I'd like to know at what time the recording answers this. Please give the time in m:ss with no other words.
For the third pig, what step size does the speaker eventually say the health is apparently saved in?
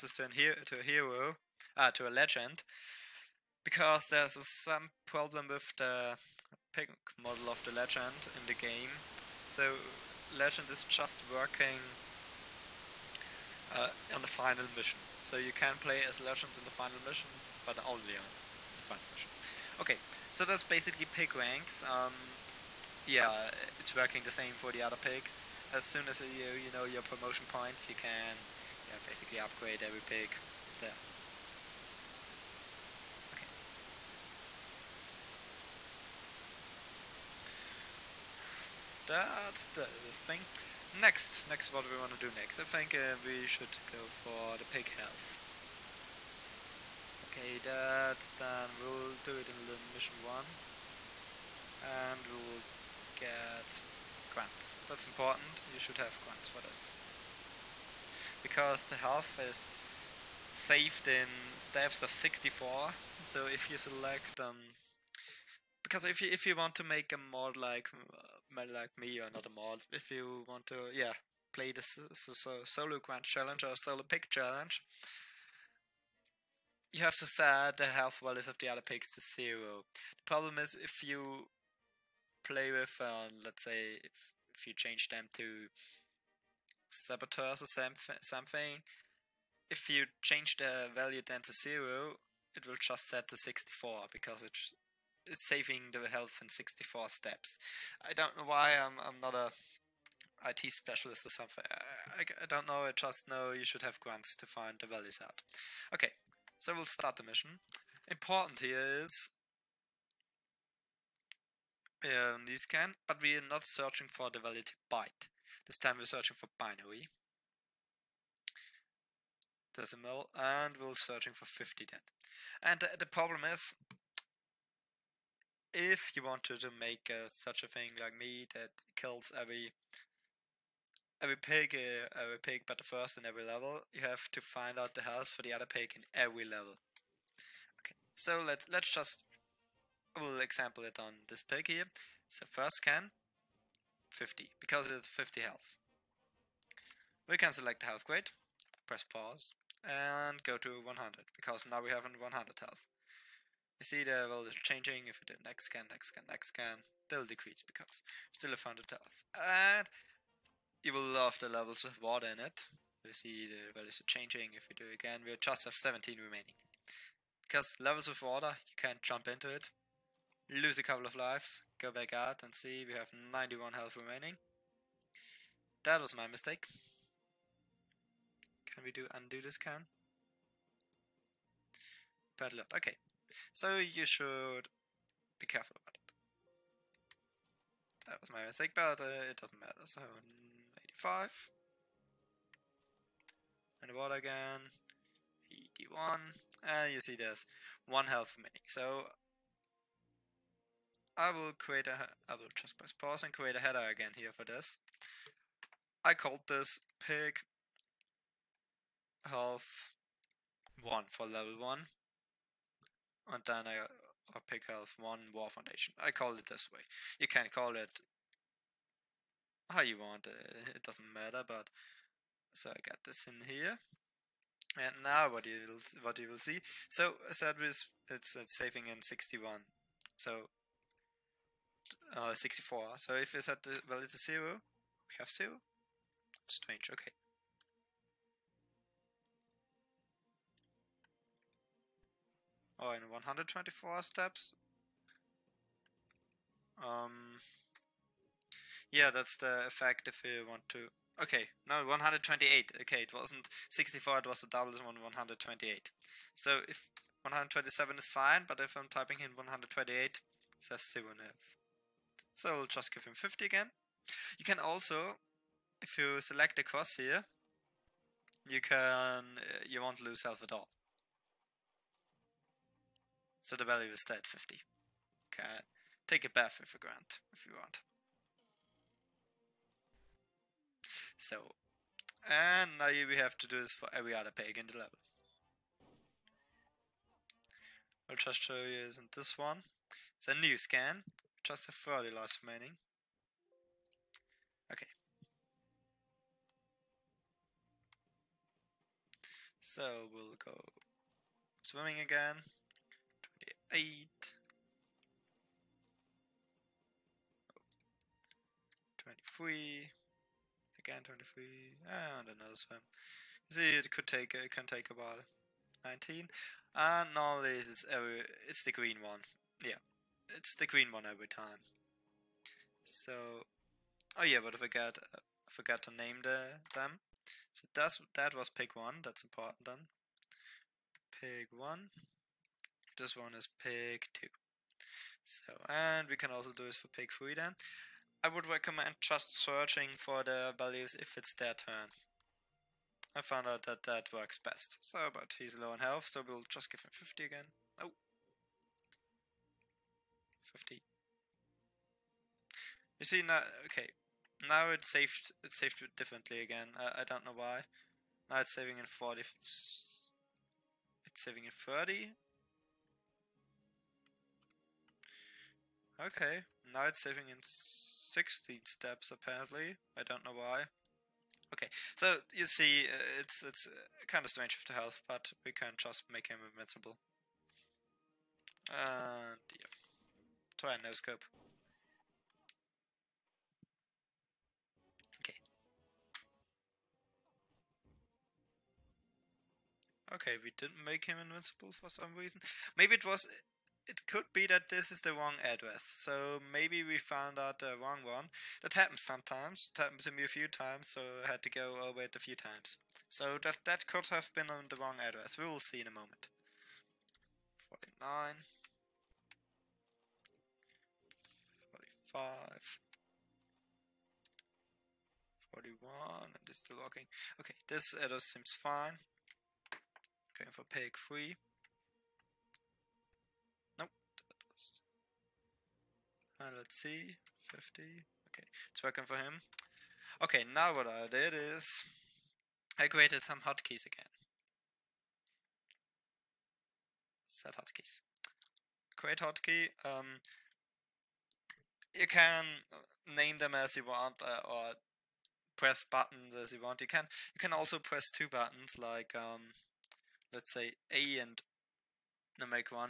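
6:08.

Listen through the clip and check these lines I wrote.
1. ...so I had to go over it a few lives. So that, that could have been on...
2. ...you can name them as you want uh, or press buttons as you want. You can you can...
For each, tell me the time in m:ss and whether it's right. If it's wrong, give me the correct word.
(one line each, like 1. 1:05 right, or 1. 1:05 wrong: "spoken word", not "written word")
1. 6:40 wrong: "times", not "lives"
2. 7:21 right.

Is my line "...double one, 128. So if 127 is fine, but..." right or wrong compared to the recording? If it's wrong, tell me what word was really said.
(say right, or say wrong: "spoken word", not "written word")
right.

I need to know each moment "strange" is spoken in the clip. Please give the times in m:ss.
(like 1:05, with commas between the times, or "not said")
3:56, 6:14.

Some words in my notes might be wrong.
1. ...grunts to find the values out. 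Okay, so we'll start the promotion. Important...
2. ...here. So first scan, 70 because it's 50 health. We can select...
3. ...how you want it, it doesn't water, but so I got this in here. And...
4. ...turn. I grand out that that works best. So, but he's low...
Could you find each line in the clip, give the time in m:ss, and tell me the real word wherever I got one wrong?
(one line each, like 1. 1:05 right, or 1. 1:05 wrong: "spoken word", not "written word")
1. 1:43 wrong: "mission", not "promotion"
2. 2:21 wrong: "50", not "70"
3. 3:39 wrong: "matter", not "water"
4. 5:41 wrong: "found", not "grand".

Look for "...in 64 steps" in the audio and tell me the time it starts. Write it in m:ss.
1:36.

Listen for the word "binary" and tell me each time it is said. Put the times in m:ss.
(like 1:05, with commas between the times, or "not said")
1:56.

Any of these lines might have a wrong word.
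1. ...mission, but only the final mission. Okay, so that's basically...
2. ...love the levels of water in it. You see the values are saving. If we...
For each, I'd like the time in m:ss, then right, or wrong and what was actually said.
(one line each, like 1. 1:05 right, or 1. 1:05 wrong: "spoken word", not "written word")
1. 0:17 right
2. 2:41 wrong: "changing", not "saving".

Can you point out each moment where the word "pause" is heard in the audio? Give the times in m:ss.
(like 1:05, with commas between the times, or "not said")
2:29, 3:22.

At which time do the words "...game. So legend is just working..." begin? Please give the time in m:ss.
0:08.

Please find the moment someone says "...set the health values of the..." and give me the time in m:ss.
1:17.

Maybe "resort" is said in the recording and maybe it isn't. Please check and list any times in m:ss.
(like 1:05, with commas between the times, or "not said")
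not said.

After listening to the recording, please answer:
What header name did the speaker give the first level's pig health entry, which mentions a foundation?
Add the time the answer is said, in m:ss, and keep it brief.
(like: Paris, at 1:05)
Pig health 1 war foundation, at 3:34.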